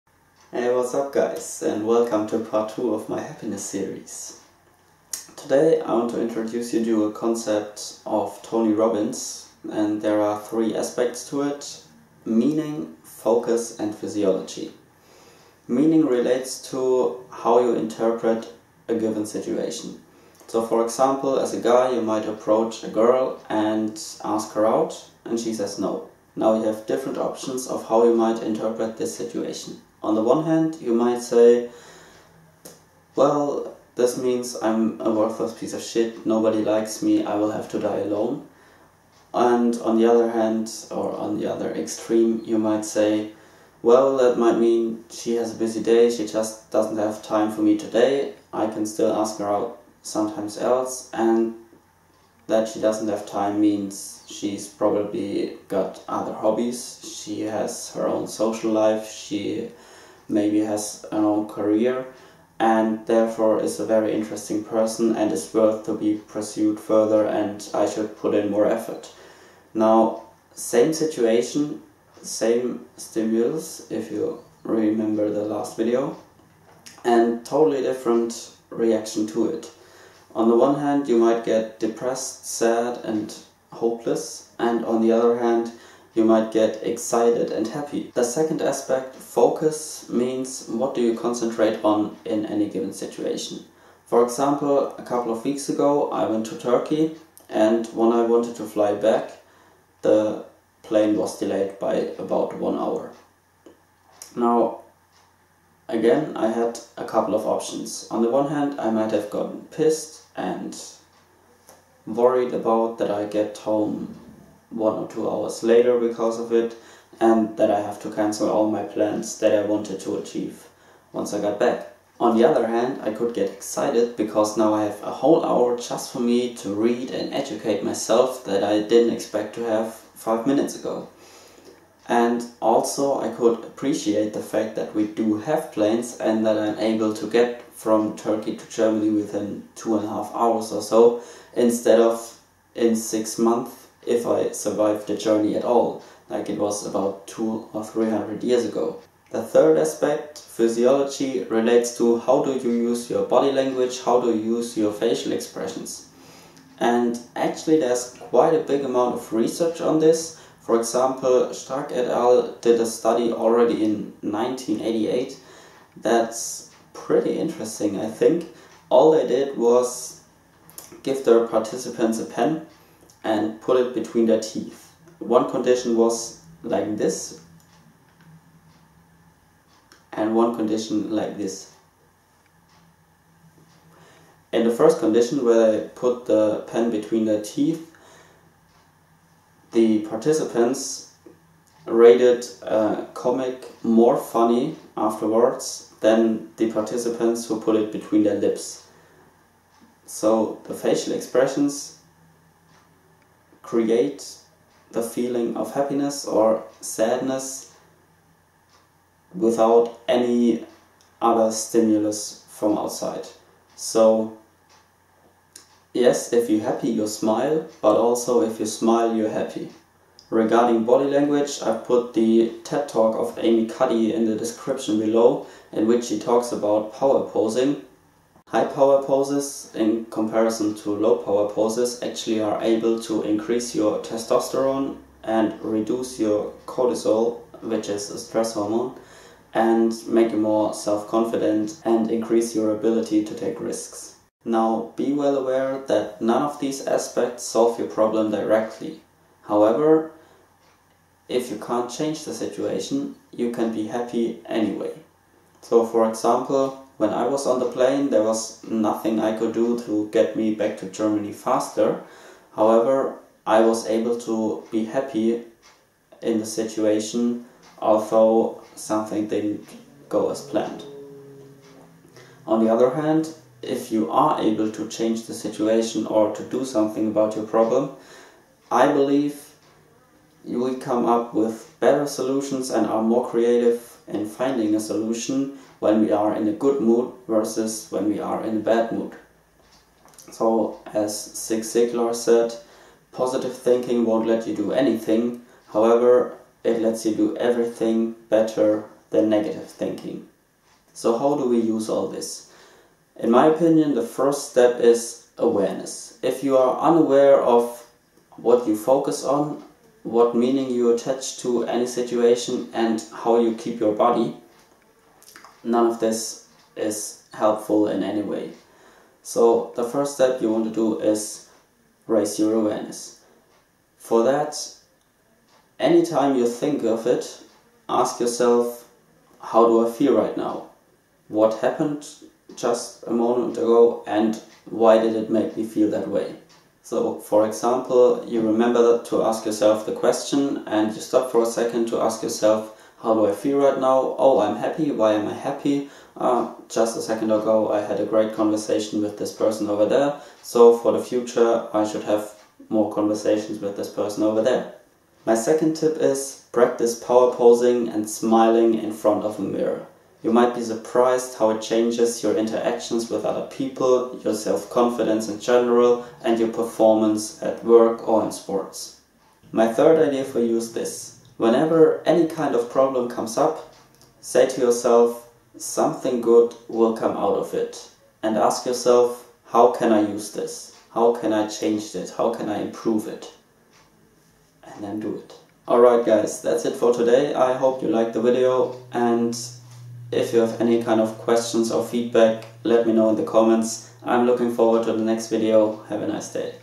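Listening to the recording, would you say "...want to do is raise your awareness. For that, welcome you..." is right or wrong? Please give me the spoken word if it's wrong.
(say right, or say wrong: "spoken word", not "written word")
wrong: "anytime", not "welcome".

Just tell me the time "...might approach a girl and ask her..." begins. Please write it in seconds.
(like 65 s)
22 s.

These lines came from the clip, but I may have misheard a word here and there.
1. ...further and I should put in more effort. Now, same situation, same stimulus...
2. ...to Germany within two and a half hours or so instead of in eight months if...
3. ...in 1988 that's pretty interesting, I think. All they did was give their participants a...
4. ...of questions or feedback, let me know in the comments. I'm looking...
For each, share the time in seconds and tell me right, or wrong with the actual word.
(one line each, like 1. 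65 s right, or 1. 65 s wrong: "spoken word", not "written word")
1. 66 s right
2. 138 s wrong: "six", not "eight"
3. 163 s right
4. 390 s right.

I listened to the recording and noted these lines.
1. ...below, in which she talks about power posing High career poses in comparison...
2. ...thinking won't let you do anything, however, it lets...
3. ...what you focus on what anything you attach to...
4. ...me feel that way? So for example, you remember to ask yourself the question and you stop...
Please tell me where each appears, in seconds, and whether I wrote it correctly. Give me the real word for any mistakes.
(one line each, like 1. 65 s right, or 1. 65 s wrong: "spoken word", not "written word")
1. 224 s wrong: "power", not "career"
2. 293 s right
3. 308 s wrong: "meaning", not "anything"
4. 335 s right.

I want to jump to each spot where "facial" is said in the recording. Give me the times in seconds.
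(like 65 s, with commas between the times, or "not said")
154 s, 200 s.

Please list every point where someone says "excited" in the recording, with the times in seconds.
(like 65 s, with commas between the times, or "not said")
86 s, 123 s.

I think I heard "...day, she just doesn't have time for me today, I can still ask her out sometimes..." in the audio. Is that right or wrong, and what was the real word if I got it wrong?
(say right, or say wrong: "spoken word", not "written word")
right.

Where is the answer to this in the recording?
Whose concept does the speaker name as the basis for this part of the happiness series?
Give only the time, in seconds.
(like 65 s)
8 s.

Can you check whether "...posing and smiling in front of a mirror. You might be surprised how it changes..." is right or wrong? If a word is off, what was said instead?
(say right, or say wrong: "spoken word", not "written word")
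right.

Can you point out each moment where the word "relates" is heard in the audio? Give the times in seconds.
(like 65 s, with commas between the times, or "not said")
16 s, 151 s.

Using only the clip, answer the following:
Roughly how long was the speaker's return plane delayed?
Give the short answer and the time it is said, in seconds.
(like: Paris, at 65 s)
1 hour, at 102 s.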